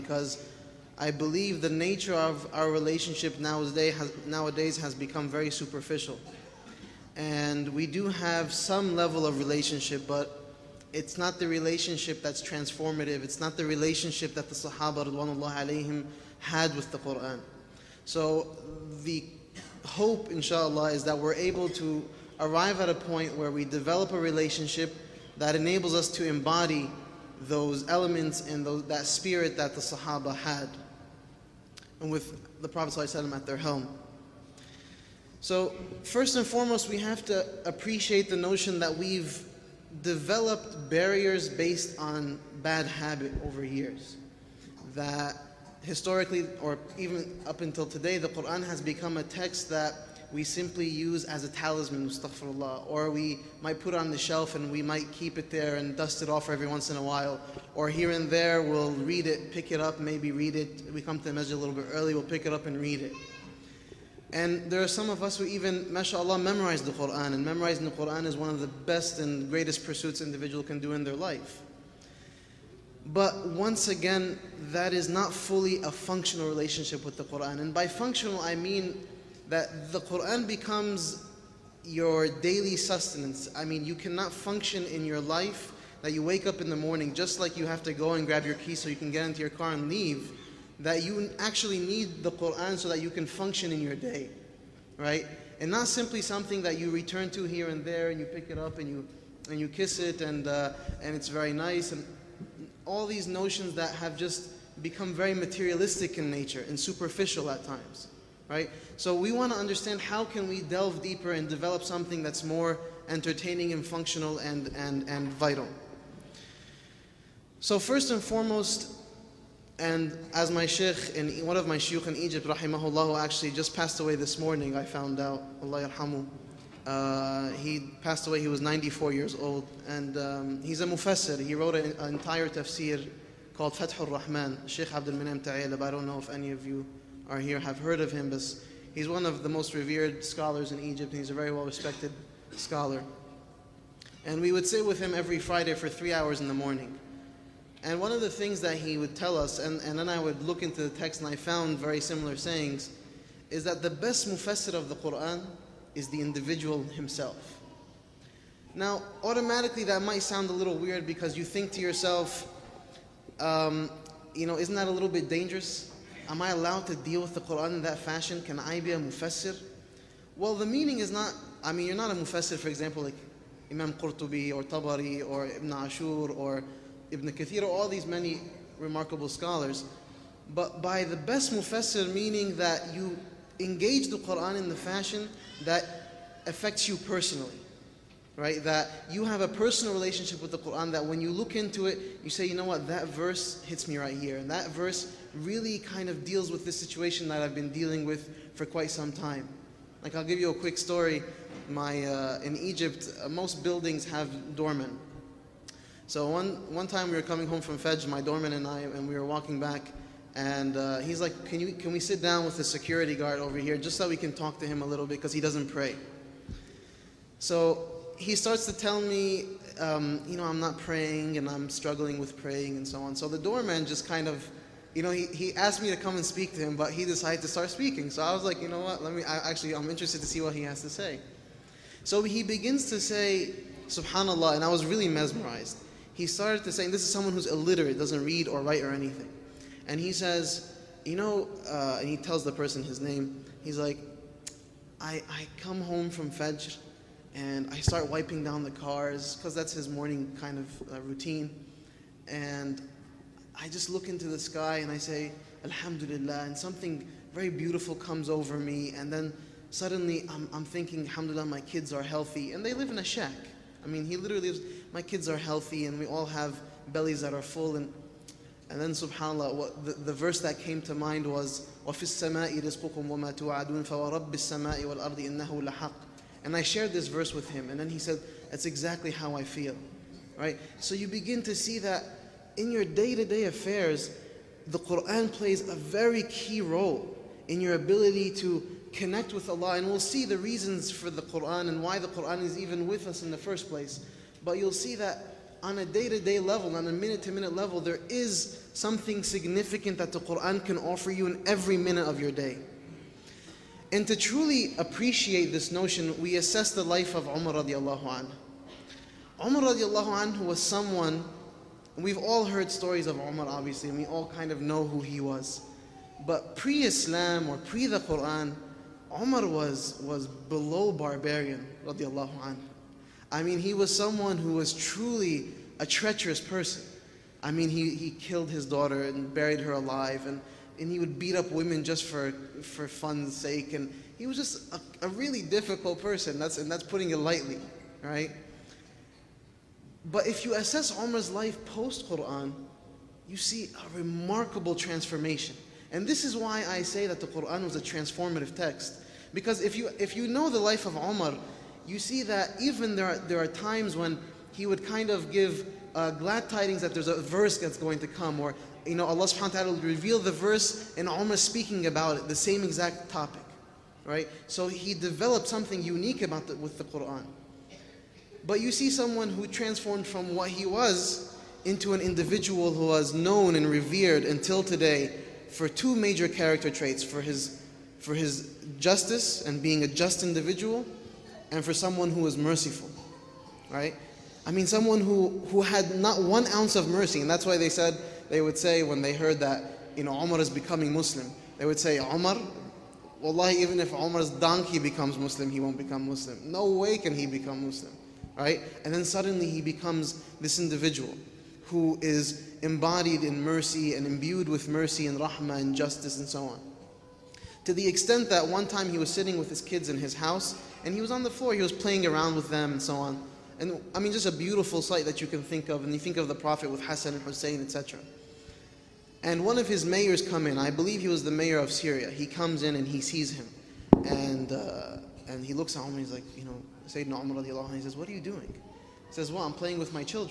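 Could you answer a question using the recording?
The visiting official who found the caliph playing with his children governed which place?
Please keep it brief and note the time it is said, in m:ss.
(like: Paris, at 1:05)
Syria, at 7:01.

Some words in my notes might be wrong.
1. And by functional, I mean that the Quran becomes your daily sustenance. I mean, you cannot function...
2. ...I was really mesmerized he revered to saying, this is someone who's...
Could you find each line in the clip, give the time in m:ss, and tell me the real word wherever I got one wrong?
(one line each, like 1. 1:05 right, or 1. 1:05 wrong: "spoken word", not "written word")
1. 1:17 right
2. 3:54 wrong: "started", not "revered".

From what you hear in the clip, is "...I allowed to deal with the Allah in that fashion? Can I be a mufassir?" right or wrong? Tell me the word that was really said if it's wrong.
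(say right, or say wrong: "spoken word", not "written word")
wrong: "Quran", not "Allah".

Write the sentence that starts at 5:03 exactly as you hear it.
And to truly appreciate this notion, we assess the life of Umar radiallahu anhu.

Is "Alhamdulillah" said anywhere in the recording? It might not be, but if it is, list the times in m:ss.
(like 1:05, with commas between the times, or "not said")
4:15, 4:21.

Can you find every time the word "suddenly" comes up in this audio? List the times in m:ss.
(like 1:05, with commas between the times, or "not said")
4:19, 6:39.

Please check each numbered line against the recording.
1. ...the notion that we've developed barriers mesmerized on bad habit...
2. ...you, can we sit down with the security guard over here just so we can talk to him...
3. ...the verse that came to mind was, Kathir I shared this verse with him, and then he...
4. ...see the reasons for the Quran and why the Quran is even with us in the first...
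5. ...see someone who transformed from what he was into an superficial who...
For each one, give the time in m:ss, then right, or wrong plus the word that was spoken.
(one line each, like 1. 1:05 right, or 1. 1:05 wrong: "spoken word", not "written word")
1. 0:38 wrong: "based", not "mesmerized"
2. 3:31 right
3. 4:29 wrong: "And", not "Kathir"
4. 4:49 right
5. 6:08 wrong: "individual", not "superficial".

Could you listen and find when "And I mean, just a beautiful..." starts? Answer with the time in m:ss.
6:53.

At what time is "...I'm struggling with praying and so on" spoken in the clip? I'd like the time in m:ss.
3:41.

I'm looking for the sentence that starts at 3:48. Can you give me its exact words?
So I was like, you know what, let me, I, actually, I'm interested to see what he has to say.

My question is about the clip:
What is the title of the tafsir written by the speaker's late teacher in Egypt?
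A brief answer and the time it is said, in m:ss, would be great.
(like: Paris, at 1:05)
Fathur Rahman, at 2:13.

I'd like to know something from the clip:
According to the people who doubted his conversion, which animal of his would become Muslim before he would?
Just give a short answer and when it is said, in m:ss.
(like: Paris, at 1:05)
Donkey, at 6:34.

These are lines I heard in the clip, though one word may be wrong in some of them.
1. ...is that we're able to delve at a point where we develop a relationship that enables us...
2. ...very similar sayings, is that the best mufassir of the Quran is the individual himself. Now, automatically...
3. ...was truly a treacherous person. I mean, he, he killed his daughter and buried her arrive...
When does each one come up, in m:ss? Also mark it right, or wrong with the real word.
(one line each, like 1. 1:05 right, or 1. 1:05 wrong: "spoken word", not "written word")
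1. 0:20 wrong: "arrive", not "delve"
2. 2:31 right
3. 5:24 wrong: "alive", not "arrive".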